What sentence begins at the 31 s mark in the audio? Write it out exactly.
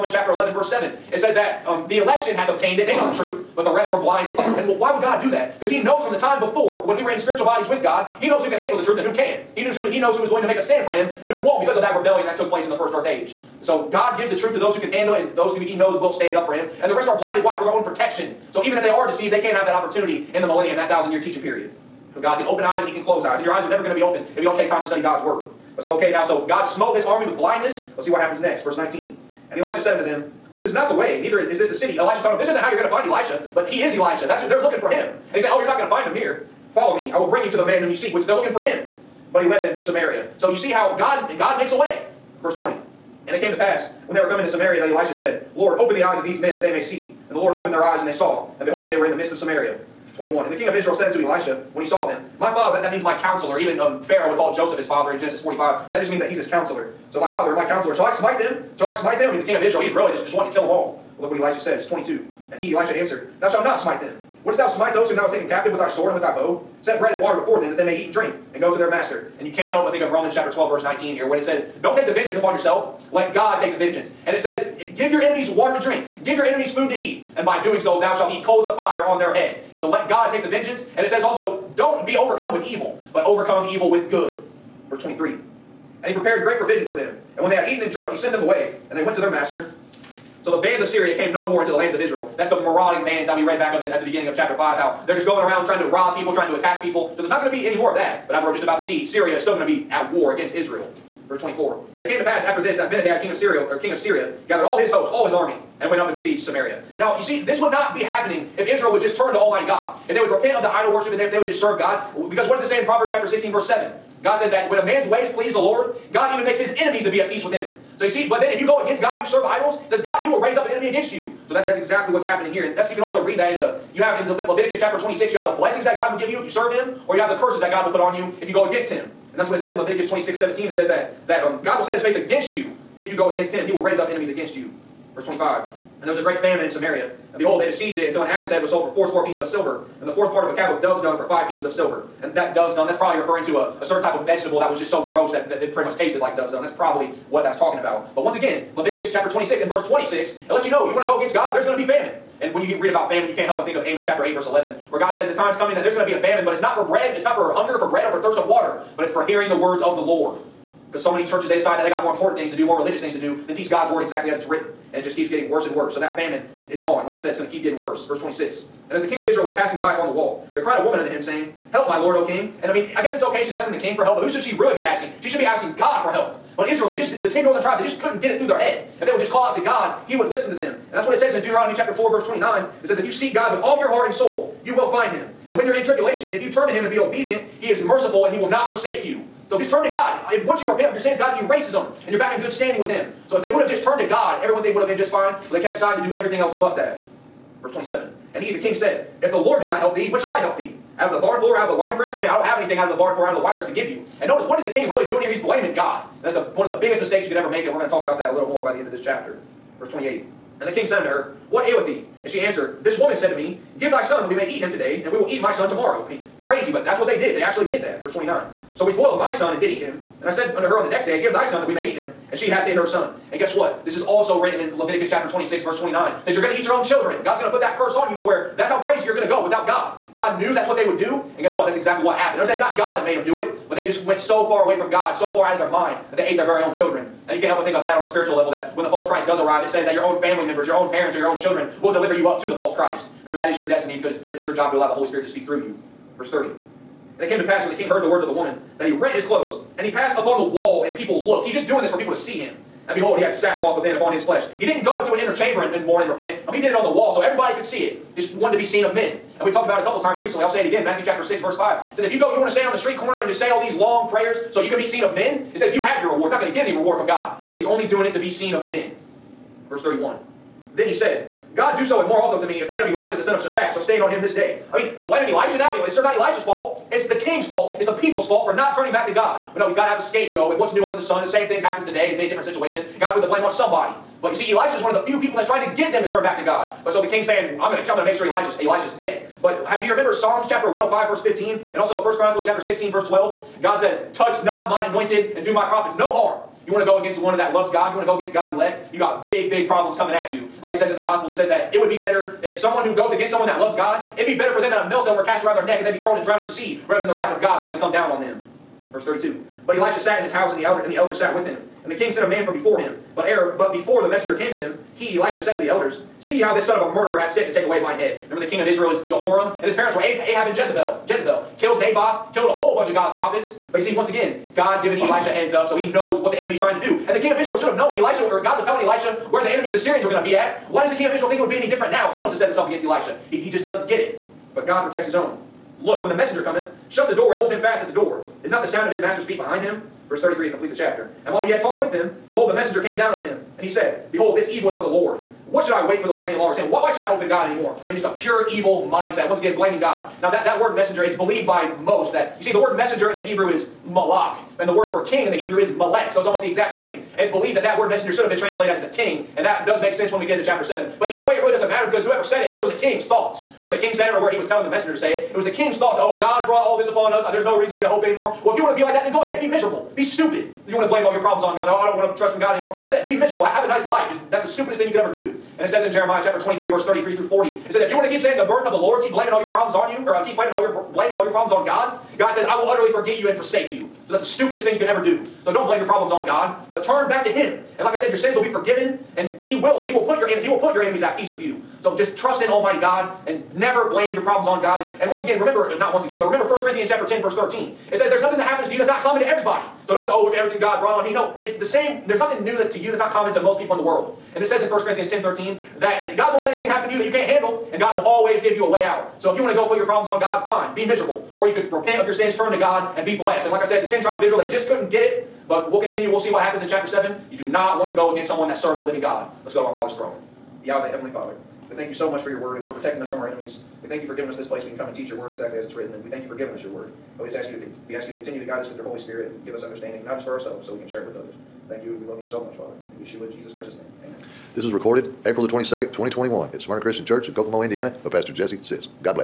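Elisha's telling them, This isn't how you're going to find Elisha, but he is Elisha.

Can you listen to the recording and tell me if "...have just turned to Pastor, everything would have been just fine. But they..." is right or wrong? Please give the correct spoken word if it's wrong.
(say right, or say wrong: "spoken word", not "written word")
wrong: "God", not "Pastor".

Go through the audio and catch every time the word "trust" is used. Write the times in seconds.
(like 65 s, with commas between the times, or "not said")
372 s, 392 s.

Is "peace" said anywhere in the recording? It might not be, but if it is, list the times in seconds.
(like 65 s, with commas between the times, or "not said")
117 s, 391 s.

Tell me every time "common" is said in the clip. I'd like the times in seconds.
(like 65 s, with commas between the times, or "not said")
399 s, 403 s.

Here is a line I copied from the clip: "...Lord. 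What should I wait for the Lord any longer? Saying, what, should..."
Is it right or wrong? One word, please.
right.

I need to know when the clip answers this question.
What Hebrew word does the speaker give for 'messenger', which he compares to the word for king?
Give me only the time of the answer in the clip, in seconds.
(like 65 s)
353 s.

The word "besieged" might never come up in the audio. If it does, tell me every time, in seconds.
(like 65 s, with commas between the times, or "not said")
106 s, 137 s.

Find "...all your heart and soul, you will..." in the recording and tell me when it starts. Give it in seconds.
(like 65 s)
183 s.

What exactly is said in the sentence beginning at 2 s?
They know the truth, but the rest were blinded.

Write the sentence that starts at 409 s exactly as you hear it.
So if you want to go put your problems on God, fine, be miserable.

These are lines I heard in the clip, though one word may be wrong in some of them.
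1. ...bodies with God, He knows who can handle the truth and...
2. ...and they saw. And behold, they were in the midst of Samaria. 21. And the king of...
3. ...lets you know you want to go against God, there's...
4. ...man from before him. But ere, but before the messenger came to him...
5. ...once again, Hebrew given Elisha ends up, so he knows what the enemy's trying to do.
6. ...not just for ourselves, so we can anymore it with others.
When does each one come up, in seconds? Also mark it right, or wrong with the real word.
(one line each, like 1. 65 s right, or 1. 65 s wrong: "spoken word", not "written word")
1. 7 s right
2. 48 s right
3. 150 s right
4. 312 s right
5. 323 s wrong: "God", not "Hebrew"
6. 430 s wrong: "share", not "anymore".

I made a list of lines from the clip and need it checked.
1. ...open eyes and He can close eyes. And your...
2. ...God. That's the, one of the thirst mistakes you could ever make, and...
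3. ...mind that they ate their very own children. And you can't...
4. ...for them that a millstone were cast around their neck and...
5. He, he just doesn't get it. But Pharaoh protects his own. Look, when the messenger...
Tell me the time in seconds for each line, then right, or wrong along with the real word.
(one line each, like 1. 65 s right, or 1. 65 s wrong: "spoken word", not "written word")
1. 22 s right
2. 205 s wrong: "biggest", not "thirst"
3. 235 s right
4. 304 s right
5. 333 s wrong: "God", not "Pharaoh".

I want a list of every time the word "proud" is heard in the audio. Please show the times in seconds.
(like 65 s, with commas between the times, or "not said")
not said.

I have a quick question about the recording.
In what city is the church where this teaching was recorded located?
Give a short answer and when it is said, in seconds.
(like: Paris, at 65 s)
Kokomo, Indiana, at 437 s.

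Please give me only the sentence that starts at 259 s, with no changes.
And we've talked about it a couple times recently.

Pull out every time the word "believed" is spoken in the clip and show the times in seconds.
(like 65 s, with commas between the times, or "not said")
351 s, 357 s.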